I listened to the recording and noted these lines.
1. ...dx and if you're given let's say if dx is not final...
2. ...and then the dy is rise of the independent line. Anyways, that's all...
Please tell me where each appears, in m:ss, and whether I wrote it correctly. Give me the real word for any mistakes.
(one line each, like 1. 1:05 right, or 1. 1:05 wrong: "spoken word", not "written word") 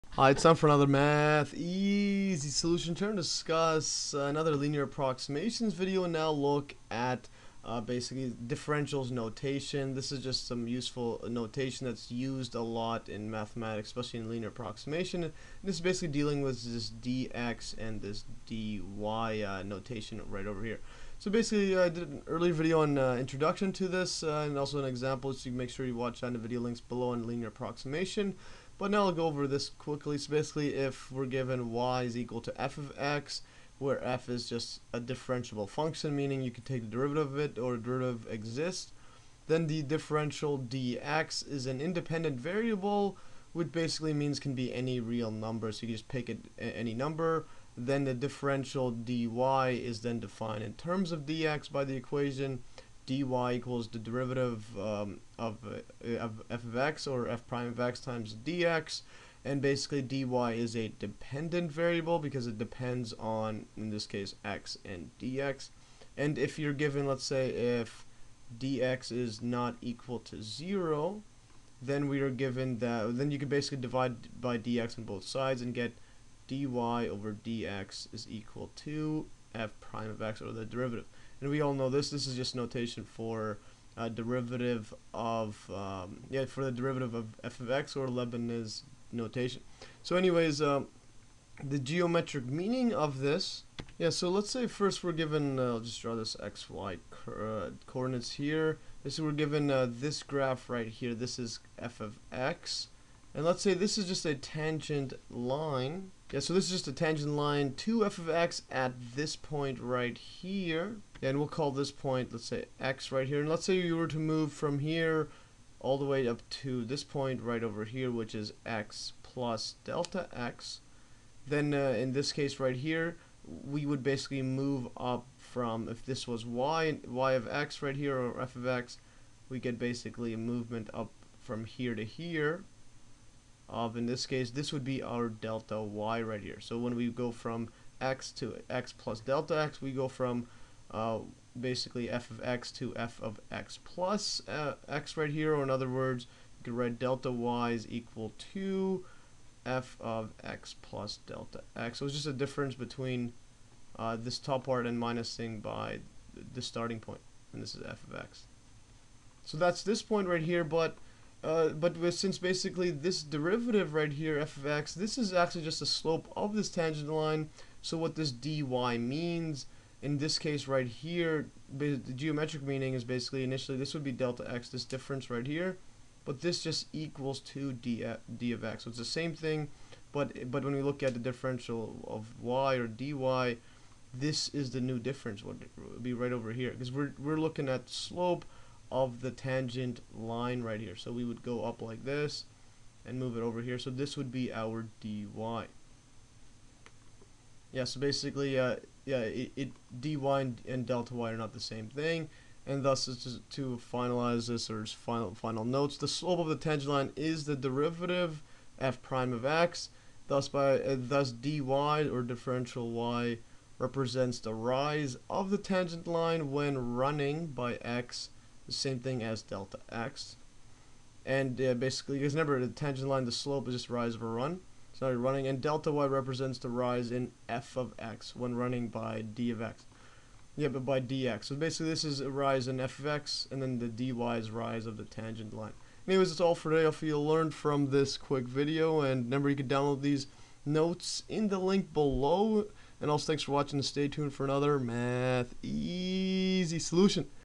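1. 1:05 wrong: "equal", not "final"
2. 3:53 wrong: "tangent", not "independent".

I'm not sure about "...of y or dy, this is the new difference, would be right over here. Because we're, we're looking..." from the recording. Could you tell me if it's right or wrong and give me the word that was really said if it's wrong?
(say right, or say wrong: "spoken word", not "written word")
right.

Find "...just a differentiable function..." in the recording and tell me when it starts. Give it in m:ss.
0:34.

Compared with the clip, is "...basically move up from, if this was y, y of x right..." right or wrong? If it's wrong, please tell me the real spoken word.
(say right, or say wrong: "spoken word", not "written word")
right.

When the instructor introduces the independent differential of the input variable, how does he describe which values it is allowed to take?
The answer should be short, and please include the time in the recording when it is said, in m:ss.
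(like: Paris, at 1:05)
any real number, at 0:44.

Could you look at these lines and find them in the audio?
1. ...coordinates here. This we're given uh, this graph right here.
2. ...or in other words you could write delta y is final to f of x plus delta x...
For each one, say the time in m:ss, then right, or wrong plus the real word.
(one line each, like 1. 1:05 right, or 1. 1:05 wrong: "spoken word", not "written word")
1. 1:37 right
2. 2:25 wrong: "equal", not "final".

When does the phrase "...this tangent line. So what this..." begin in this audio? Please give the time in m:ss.
2:46.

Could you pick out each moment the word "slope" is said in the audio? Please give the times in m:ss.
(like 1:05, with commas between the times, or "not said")
2:45, 3:07, 3:26, 3:43.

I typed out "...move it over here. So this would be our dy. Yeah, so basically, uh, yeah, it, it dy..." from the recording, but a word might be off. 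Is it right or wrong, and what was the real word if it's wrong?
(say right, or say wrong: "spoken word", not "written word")
right.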